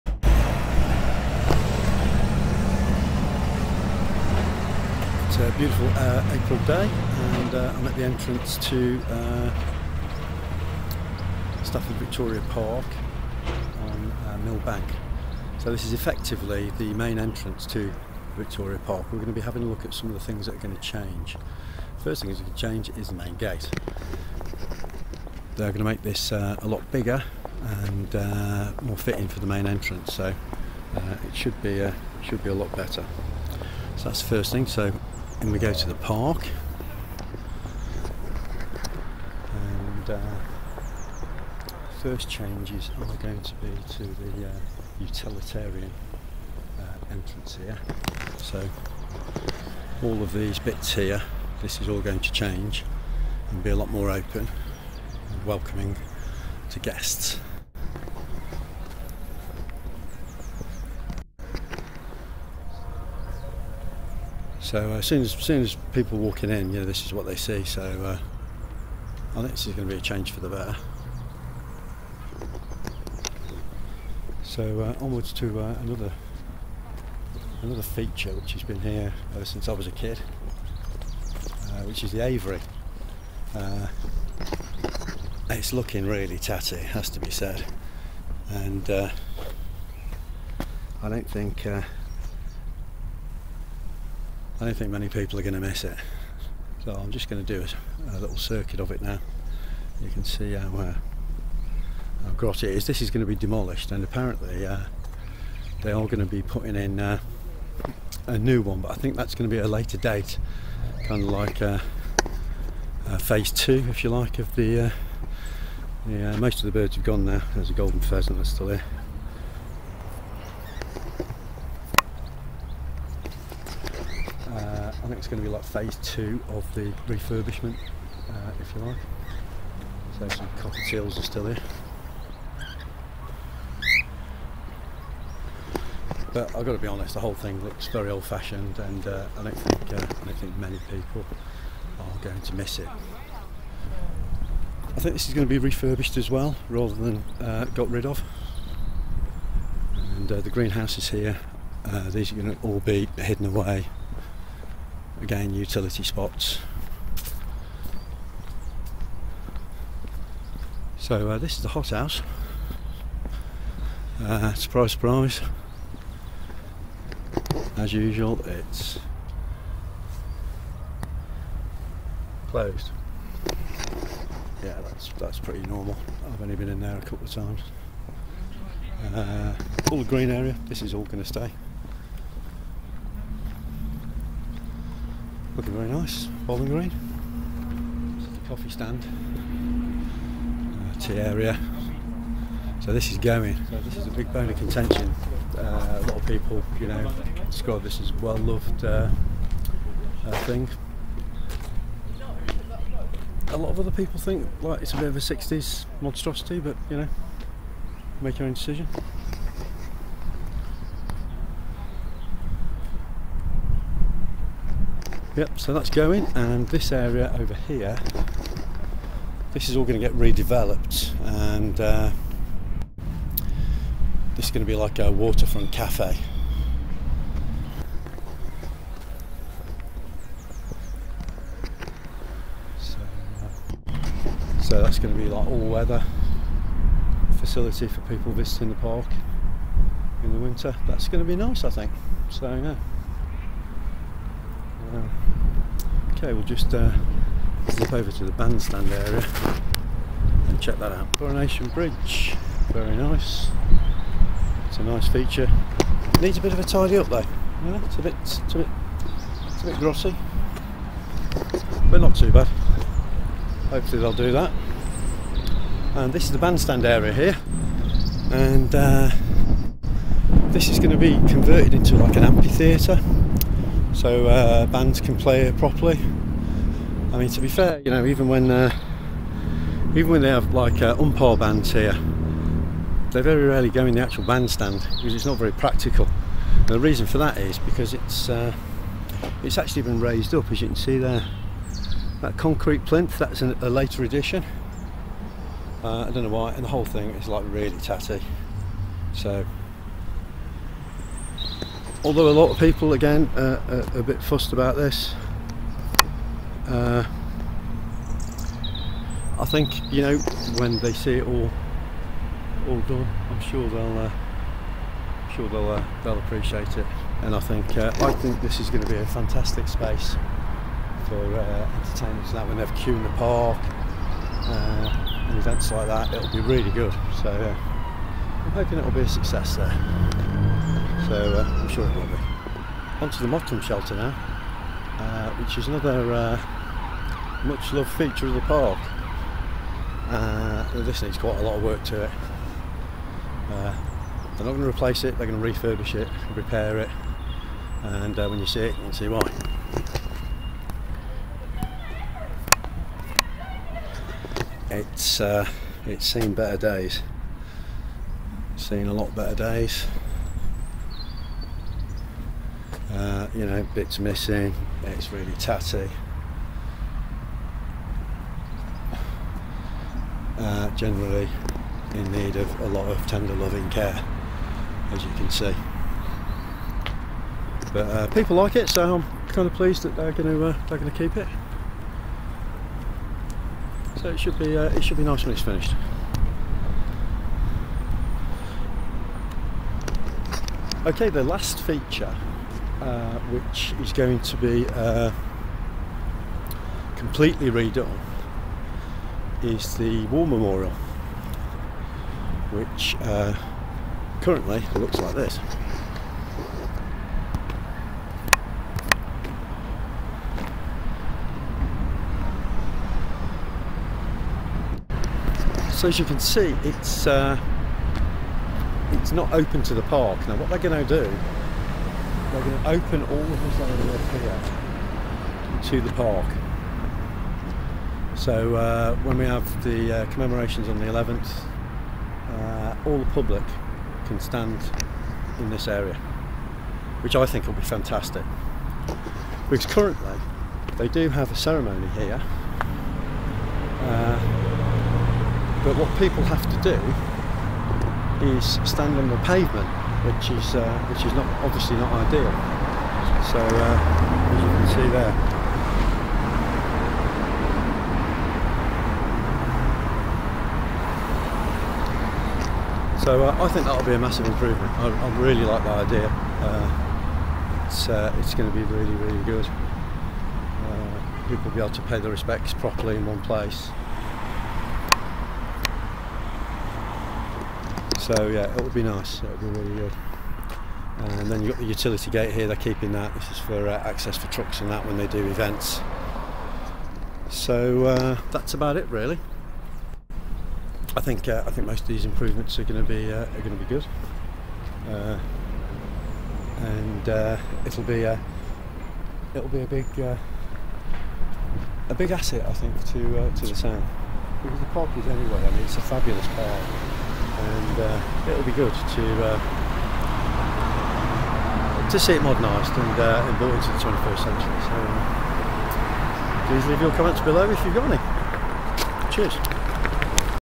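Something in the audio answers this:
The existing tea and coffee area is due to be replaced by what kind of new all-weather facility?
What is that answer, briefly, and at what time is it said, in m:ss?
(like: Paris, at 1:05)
waterfront cafe, at 3:45.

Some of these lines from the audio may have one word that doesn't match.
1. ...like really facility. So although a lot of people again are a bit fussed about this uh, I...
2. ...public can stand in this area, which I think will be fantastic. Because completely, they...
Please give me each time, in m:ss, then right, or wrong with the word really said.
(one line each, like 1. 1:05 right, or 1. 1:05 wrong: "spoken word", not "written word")
1. 4:57 wrong: "tatty", not "facility"
2. 7:13 wrong: "currently", not "completely".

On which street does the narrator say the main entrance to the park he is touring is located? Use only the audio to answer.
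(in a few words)
Millbank.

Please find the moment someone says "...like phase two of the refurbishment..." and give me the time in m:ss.
2:05.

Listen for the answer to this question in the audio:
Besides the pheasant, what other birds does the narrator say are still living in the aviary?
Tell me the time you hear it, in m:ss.
2:10.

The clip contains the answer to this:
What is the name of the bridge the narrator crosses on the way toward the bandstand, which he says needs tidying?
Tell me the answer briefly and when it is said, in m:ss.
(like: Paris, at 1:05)
Coronation Bridge, at 4:11.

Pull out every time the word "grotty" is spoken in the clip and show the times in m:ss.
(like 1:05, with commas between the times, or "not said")
1:42, 4:19.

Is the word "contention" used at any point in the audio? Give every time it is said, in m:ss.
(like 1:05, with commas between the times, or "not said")
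3:14.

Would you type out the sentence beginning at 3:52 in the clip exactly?
So, so that's going to be like all weather facility for people visiting the park in the winter.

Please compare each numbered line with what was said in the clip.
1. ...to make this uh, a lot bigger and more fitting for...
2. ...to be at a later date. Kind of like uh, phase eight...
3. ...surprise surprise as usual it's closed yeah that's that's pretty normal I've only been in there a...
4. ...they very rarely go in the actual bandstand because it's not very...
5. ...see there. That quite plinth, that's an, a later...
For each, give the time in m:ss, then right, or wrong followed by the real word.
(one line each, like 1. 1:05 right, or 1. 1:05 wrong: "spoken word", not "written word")
1. 0:25 right
2. 1:49 wrong: "two", not "eight"
3. 2:44 right
4. 4:43 right
5. 4:50 wrong: "concrete", not "quite".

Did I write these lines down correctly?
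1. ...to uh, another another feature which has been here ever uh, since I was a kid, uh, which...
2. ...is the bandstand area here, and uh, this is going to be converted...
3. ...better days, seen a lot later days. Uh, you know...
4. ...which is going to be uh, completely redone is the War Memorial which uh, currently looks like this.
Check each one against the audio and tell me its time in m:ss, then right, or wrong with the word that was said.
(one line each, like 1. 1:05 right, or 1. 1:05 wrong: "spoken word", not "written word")
1. 1:15 right
2. 4:26 right
3. 5:56 wrong: "better", not "later"
4. 6:33 right.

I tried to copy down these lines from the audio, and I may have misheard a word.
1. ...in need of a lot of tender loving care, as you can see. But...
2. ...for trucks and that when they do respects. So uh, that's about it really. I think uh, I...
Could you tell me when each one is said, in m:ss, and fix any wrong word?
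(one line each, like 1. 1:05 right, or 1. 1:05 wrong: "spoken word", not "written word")
1. 6:11 right
2. 8:04 wrong: "events", not "respects".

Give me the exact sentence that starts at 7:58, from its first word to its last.
So yeah, it would be nice.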